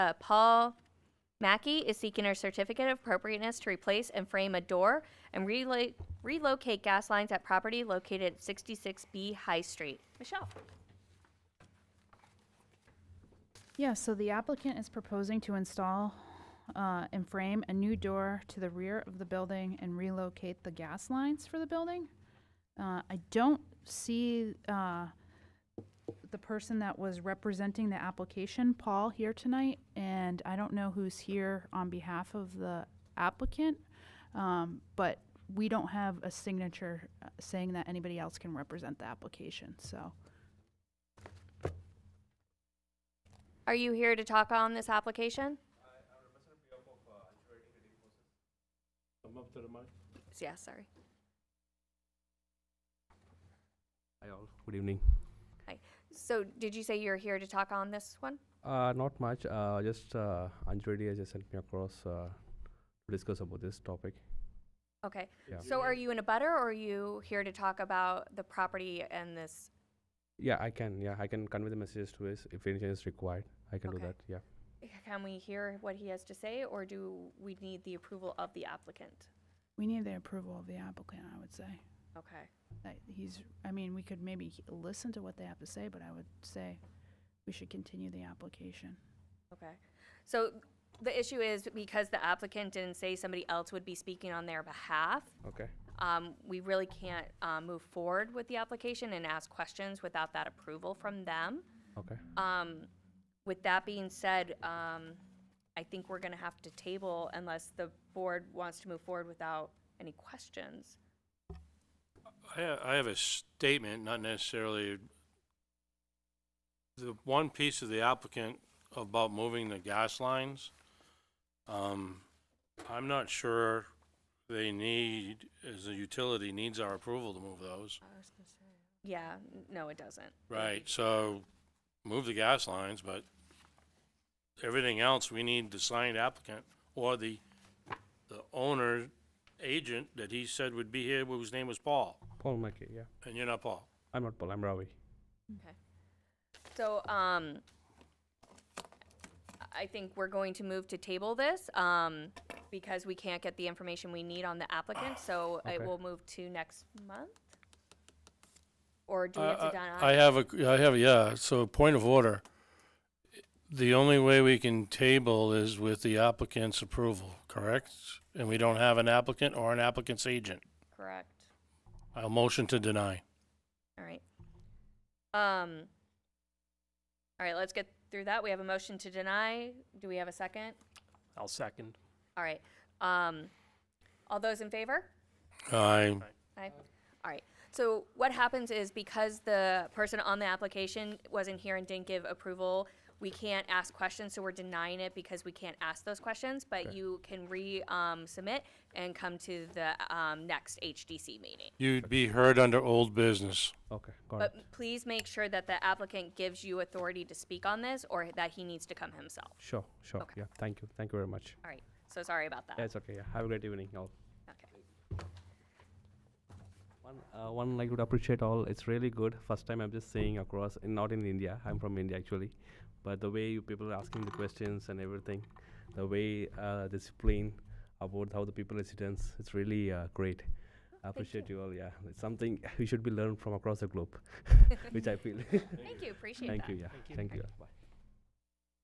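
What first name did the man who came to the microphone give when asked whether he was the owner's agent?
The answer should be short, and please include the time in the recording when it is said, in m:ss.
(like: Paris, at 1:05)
Ravi, at 2:24.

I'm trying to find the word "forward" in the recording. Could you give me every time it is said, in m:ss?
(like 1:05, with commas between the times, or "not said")
1:37, 1:49.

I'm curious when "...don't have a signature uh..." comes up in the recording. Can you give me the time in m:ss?
0:35.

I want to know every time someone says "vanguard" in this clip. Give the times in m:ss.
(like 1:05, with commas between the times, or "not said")
not said.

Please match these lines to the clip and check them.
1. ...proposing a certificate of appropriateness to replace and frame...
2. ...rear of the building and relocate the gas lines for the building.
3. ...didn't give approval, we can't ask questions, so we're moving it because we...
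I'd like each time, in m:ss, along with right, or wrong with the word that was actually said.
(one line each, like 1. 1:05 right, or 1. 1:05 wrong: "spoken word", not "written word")
1. 0:01 wrong: "seeking", not "proposing"
2. 0:18 right
3. 3:11 wrong: "denying", not "moving".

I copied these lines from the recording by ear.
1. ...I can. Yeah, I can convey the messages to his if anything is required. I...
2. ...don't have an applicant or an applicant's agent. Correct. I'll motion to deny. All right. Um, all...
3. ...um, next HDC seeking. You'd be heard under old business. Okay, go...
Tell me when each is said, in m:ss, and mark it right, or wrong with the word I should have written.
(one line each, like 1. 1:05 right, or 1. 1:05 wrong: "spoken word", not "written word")
1. 1:10 right
2. 2:48 right
3. 3:20 wrong: "meeting", not "seeking".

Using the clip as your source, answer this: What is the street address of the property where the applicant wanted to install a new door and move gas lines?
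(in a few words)
66B High Street.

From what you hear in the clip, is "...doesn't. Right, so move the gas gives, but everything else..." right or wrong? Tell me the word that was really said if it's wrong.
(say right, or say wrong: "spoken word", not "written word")
wrong: "lines", not "gives".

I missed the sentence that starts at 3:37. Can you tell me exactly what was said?
One, uh, one like would appreciate all.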